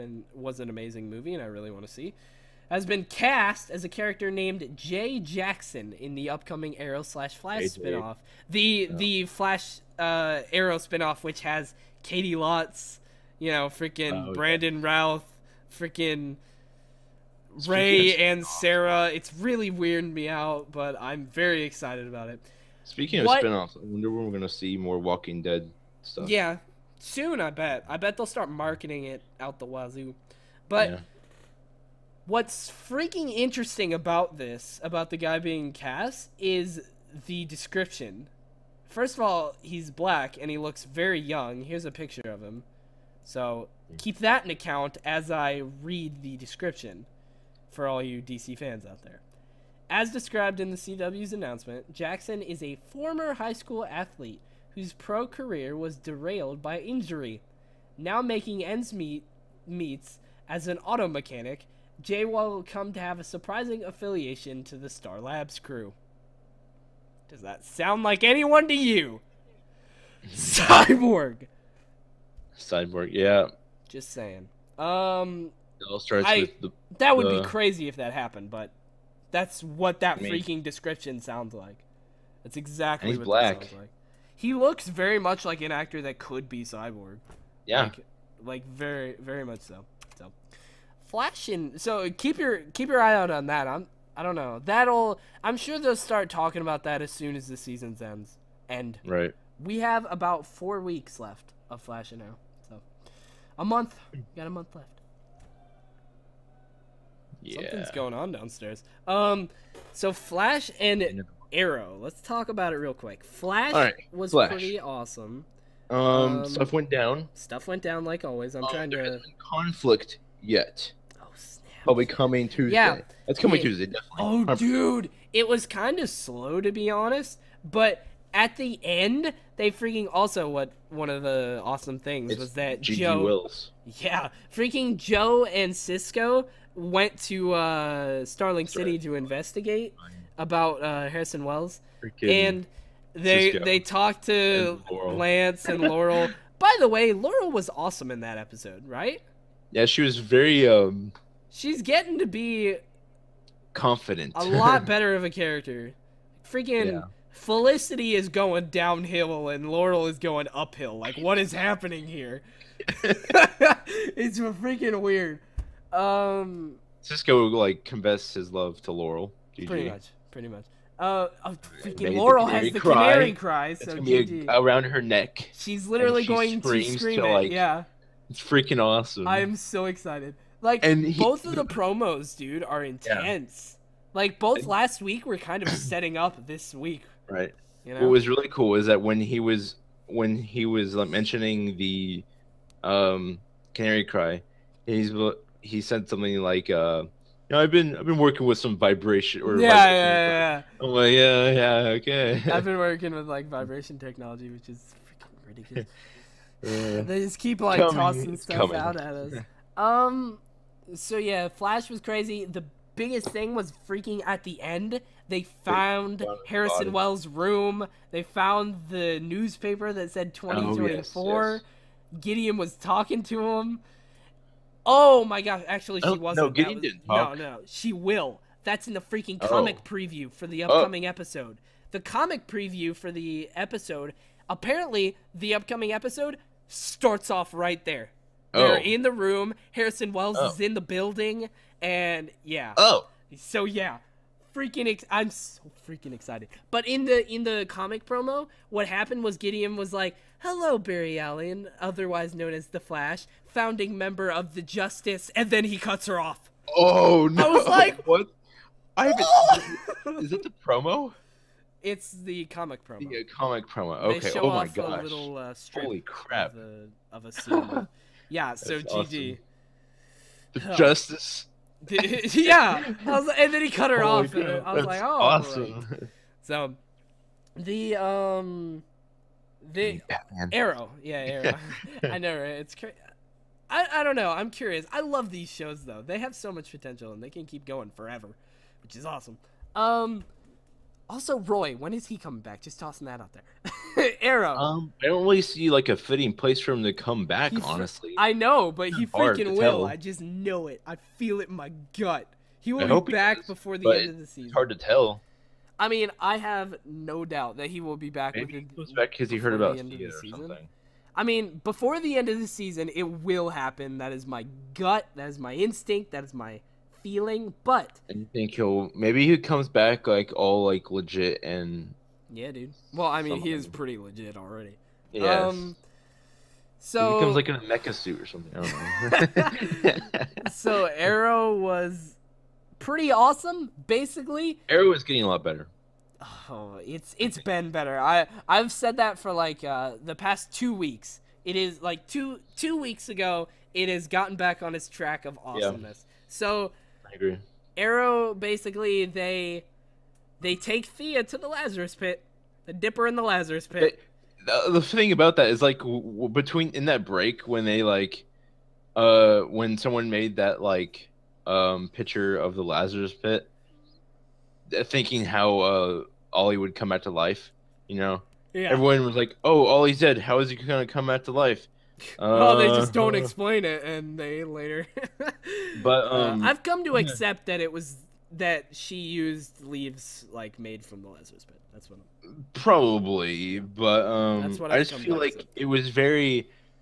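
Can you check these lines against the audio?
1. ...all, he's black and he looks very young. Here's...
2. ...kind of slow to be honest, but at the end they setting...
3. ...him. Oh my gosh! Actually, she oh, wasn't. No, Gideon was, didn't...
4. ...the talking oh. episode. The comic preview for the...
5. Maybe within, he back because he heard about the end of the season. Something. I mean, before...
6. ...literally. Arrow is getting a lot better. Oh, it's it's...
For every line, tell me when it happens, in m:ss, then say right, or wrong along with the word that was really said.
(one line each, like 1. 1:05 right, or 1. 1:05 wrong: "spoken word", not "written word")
1. 0:39 right
2. 2:05 wrong: "freaking", not "setting"
3. 3:43 right
4. 3:50 wrong: "upcoming", not "talking"
5. 5:08 right
6. 5:33 wrong: "basically", not "literally".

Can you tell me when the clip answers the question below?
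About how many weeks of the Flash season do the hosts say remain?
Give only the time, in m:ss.
1:40.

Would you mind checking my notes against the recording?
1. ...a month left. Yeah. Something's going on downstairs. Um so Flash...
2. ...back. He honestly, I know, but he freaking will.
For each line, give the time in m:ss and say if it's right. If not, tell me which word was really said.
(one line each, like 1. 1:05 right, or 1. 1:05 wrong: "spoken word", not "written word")
1. 1:44 right
2. 4:57 right.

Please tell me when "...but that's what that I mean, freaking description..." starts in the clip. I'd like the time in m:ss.
1:18.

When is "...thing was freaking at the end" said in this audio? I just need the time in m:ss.
3:33.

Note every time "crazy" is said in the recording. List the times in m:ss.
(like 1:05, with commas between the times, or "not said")
1:17, 3:31, 4:42.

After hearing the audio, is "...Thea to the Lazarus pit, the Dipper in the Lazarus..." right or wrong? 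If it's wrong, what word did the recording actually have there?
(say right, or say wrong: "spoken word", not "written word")
right.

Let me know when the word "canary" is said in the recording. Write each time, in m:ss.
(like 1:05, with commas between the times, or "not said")
2:53, 3:13.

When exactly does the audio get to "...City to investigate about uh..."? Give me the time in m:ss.
2:18.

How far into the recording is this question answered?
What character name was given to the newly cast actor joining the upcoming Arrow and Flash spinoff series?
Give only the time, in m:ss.
0:04.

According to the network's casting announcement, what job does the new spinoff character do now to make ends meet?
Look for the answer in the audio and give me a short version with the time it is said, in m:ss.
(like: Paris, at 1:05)
auto mechanic, at 1:00.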